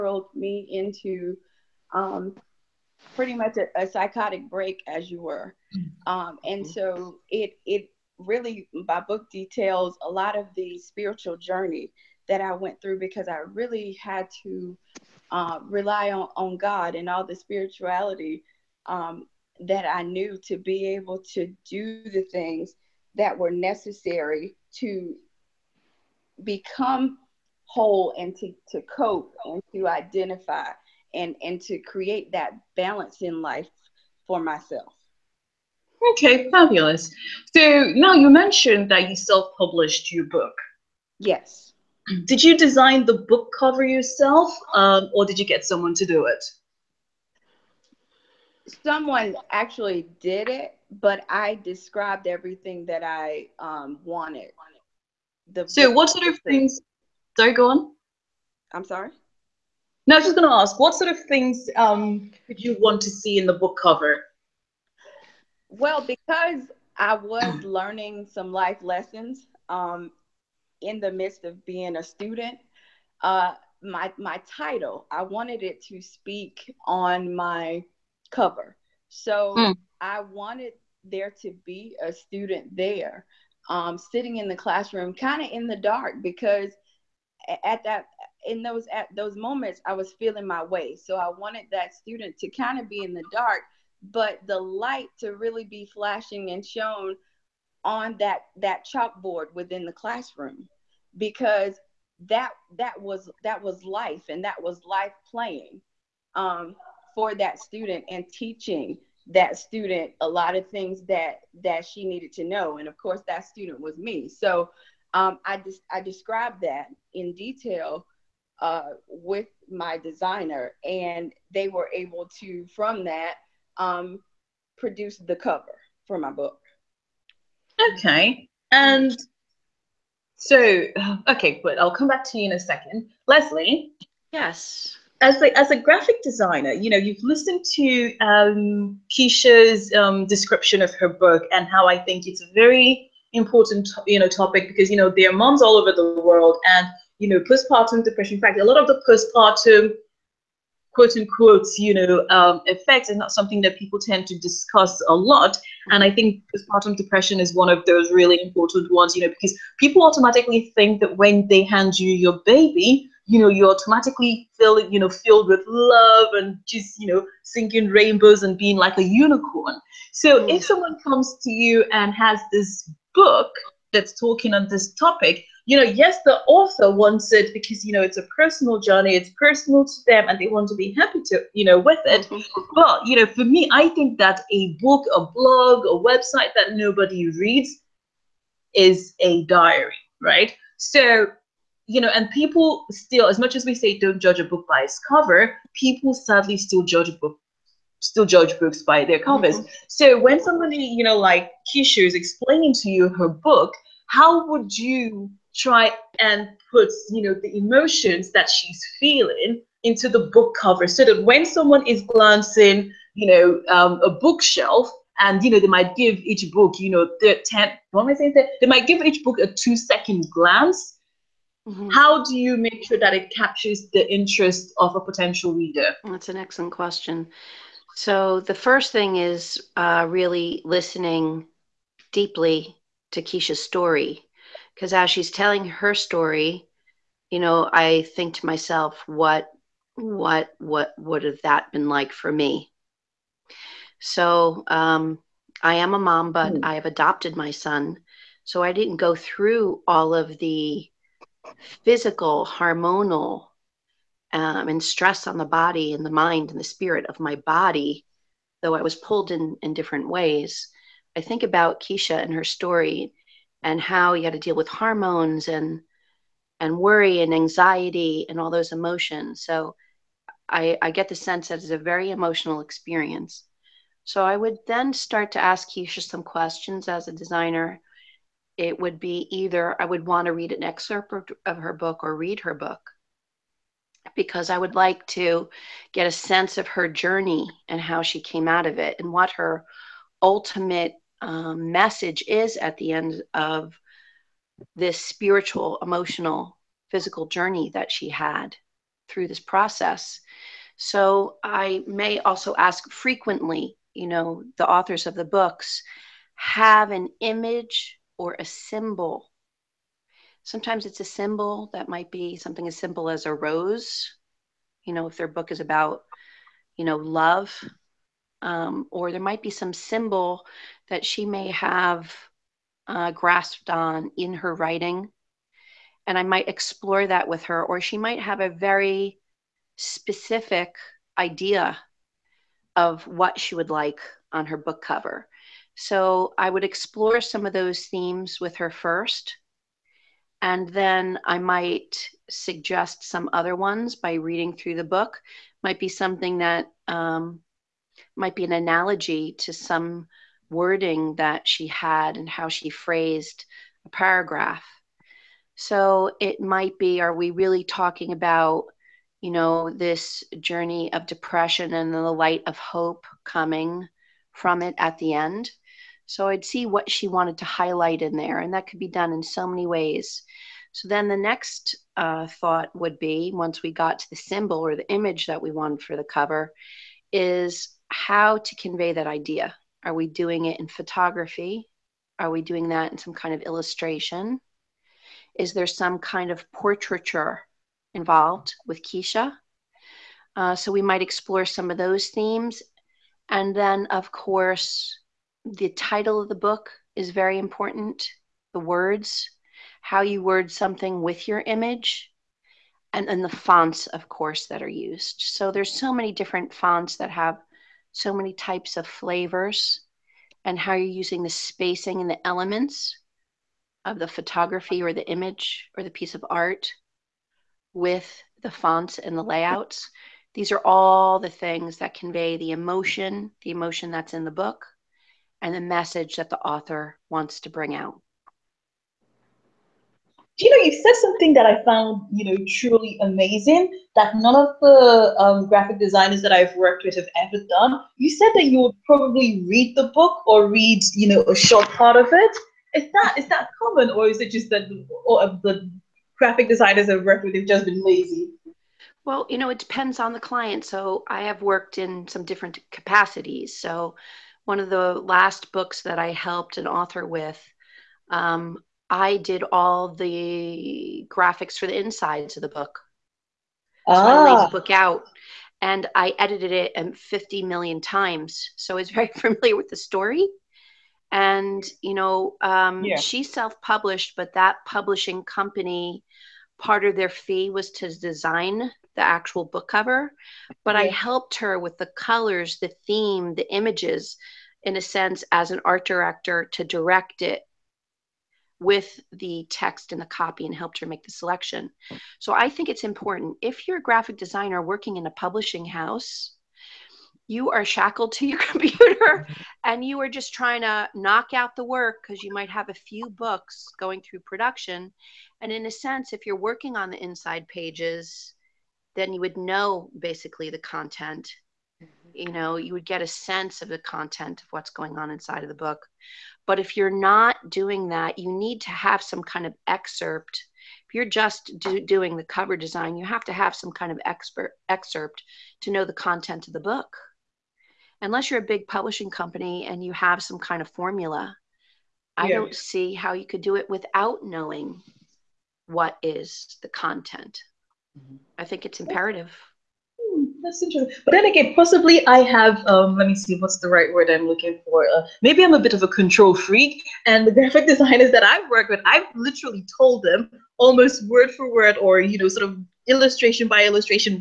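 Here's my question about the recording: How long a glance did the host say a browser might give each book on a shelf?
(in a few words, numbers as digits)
2 seconds.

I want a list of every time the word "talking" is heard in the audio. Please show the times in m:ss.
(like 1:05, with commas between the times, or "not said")
2:54, 5:57.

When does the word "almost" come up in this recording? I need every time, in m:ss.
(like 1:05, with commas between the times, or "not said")
9:10.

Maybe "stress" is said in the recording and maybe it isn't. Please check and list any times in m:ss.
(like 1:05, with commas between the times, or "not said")
4:14.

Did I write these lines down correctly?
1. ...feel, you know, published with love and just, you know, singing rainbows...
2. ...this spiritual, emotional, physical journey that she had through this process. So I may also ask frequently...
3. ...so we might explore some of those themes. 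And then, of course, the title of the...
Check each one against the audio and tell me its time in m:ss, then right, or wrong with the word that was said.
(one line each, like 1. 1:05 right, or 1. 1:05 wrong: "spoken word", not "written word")
1. 2:44 wrong: "filled", not "published"
2. 4:54 right
3. 6:30 right.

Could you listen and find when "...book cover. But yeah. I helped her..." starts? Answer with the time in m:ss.
7:59.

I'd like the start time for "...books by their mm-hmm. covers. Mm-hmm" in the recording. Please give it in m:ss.
3:18.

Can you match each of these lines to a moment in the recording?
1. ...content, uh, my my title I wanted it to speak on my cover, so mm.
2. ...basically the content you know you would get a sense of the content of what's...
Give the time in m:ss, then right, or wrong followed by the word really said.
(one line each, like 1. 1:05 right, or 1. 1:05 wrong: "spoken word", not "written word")
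1. 1:12 wrong: "student", not "content"
2. 8:29 right.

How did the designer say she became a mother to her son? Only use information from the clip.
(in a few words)
Adopted.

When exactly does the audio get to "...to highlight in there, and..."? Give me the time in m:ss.
6:07.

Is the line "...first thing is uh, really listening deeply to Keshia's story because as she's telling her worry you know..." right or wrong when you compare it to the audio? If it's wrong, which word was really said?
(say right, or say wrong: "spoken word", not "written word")
wrong: "story", not "worry".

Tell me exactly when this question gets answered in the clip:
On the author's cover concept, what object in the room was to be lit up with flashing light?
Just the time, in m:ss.
1:38.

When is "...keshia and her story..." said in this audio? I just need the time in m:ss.
4:21.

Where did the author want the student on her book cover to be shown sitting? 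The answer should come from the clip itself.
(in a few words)
In the classroom.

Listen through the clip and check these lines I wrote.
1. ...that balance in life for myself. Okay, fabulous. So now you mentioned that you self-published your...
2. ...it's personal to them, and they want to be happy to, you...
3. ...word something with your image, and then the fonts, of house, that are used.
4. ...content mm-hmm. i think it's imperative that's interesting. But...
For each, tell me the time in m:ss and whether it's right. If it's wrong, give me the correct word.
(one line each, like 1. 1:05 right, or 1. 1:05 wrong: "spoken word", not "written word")
1. 0:32 right
2. 2:59 right
3. 6:40 wrong: "course", not "house"
4. 8:56 right.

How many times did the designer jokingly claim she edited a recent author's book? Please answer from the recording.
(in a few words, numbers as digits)
50 million.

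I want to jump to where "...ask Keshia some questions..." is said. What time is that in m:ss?
4:35.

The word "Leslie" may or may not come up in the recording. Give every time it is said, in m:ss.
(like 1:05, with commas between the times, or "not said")
2:13.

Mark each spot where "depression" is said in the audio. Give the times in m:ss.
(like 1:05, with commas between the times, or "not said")
2:28, 2:36, 6:01.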